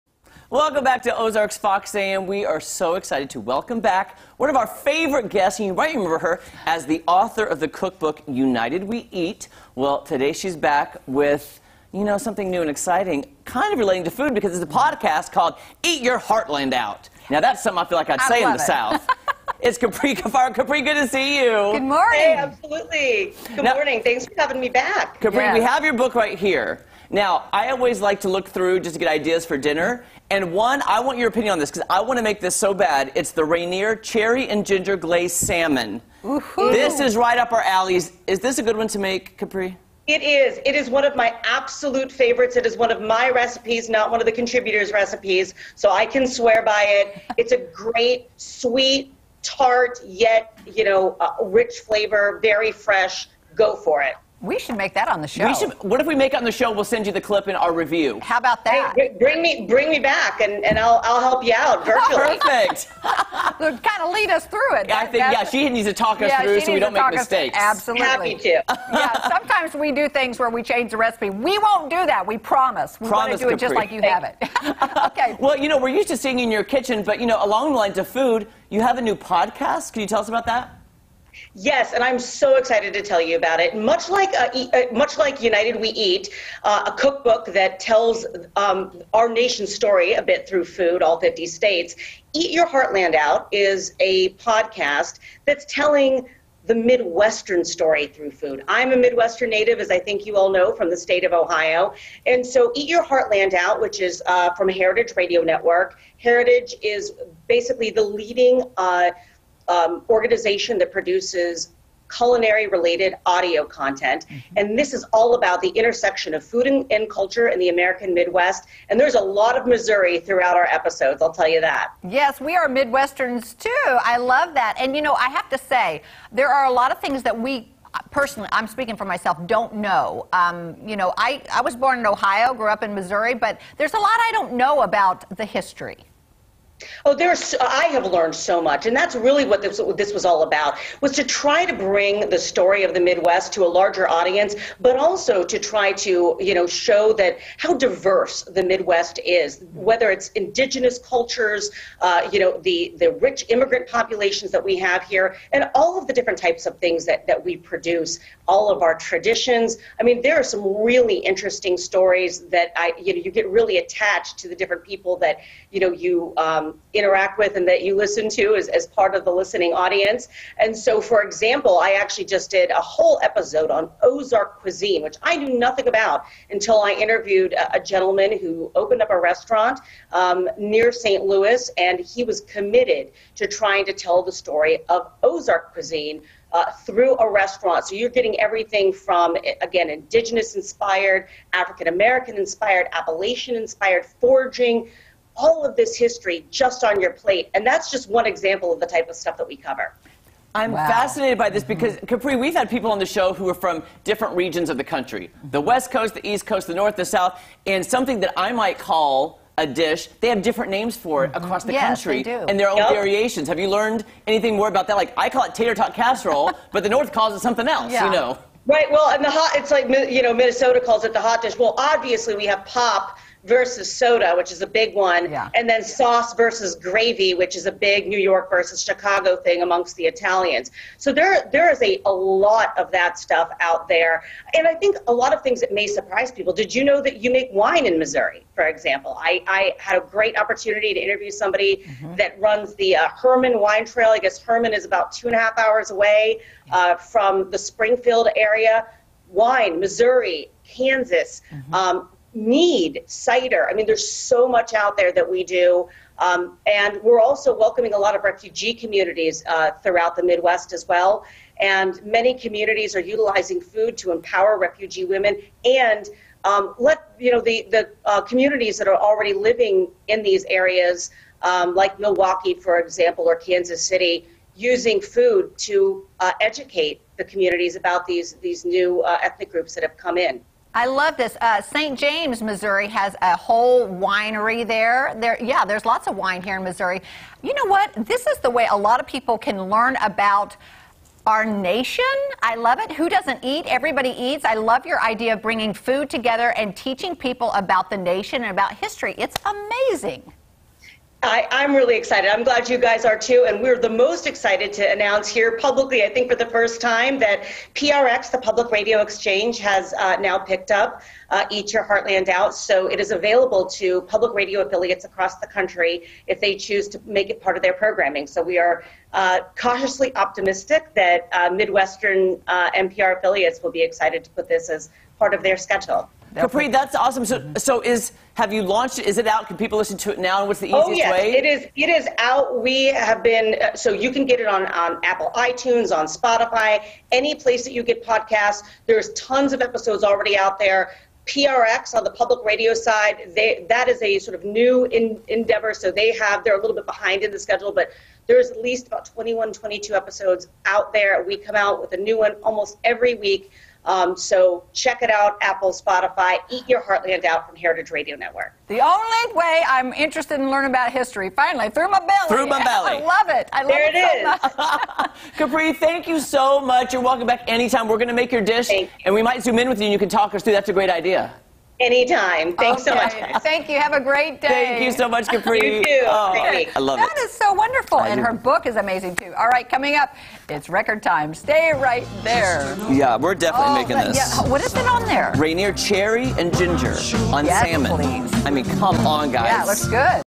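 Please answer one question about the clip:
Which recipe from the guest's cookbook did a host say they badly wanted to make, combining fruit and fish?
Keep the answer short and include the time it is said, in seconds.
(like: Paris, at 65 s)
Rainier Cherry and Ginger Glazed Salmon, at 33 s.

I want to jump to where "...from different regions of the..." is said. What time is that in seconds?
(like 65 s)
203 s.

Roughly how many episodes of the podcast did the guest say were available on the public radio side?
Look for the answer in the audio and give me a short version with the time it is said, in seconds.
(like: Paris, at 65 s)
21 or 22, at 349 s.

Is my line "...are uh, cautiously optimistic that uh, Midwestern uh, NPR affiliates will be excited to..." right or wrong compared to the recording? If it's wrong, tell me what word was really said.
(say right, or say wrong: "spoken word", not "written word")
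right.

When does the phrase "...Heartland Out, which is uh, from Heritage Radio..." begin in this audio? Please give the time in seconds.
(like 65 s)
103 s.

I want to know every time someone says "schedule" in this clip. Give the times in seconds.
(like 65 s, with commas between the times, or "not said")
325 s, 347 s.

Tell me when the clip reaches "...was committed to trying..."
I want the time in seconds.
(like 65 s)
182 s.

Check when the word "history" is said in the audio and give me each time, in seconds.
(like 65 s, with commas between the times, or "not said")
135 s, 195 s, 298 s, 360 s.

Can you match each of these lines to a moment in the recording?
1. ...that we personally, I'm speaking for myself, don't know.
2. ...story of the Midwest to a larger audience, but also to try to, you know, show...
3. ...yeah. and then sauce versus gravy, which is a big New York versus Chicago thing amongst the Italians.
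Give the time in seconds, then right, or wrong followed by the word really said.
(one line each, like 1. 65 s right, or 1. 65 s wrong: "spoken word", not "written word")
1. 127 s right
2. 142 s right
3. 225 s right.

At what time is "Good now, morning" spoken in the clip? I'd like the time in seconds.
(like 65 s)
23 s.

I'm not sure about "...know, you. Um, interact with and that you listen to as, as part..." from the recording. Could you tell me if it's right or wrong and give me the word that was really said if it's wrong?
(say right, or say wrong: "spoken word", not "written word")
right.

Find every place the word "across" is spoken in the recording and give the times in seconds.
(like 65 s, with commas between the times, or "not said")
211 s, 315 s.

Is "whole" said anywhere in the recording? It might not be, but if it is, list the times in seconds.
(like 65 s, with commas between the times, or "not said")
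172 s, 283 s.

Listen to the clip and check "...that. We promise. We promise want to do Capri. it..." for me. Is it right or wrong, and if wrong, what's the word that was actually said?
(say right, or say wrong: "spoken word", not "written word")
right.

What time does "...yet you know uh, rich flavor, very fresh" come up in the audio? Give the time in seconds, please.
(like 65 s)
50 s.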